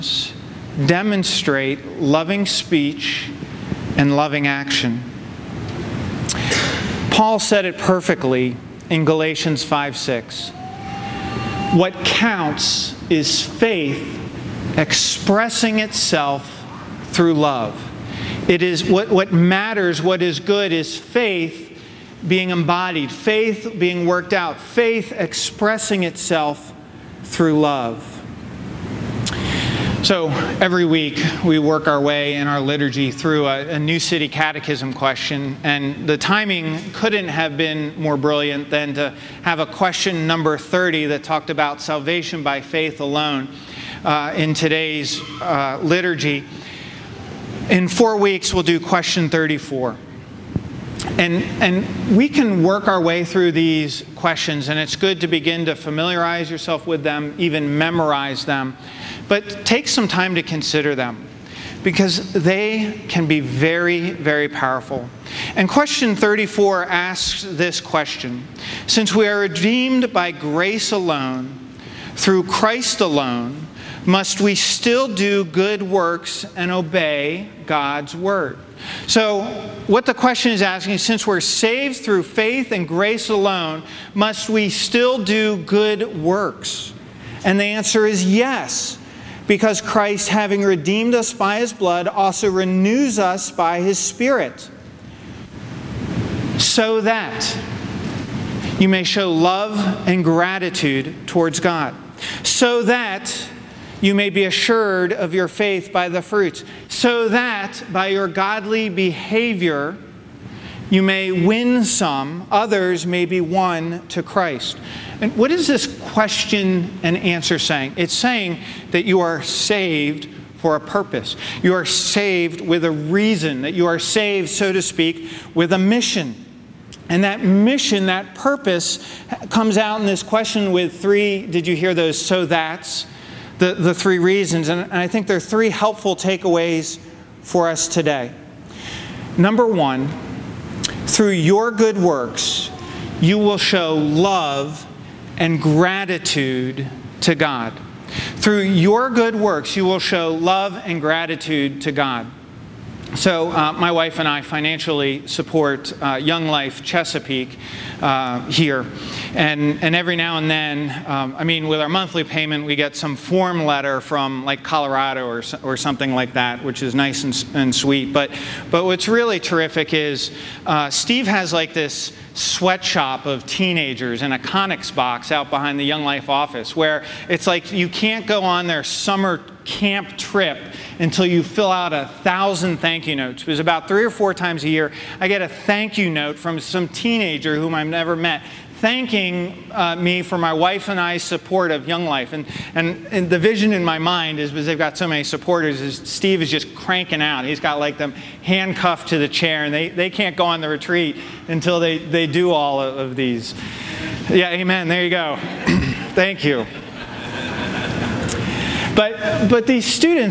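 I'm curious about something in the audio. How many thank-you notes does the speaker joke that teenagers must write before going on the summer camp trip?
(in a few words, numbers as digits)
1000.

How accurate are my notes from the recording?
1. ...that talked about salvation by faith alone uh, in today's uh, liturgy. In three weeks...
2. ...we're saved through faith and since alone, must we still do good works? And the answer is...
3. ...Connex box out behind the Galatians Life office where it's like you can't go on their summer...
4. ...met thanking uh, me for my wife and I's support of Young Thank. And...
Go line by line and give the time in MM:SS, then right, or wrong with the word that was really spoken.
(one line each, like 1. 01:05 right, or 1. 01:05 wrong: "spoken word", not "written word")
1. 00:41 wrong: "four", not "three"
2. 01:21 wrong: "grace", not "since"
3. 02:54 wrong: "Young", not "Galatians"
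4. 03:08 wrong: "Life", not "Thank".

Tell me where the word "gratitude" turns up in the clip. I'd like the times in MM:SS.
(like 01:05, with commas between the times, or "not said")
01:40, 02:25, 02:31.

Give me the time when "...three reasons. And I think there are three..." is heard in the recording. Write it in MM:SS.
02:13.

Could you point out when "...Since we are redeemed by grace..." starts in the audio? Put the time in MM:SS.
01:08.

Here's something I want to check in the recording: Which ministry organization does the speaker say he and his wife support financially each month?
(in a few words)
Young Life Chesapeake.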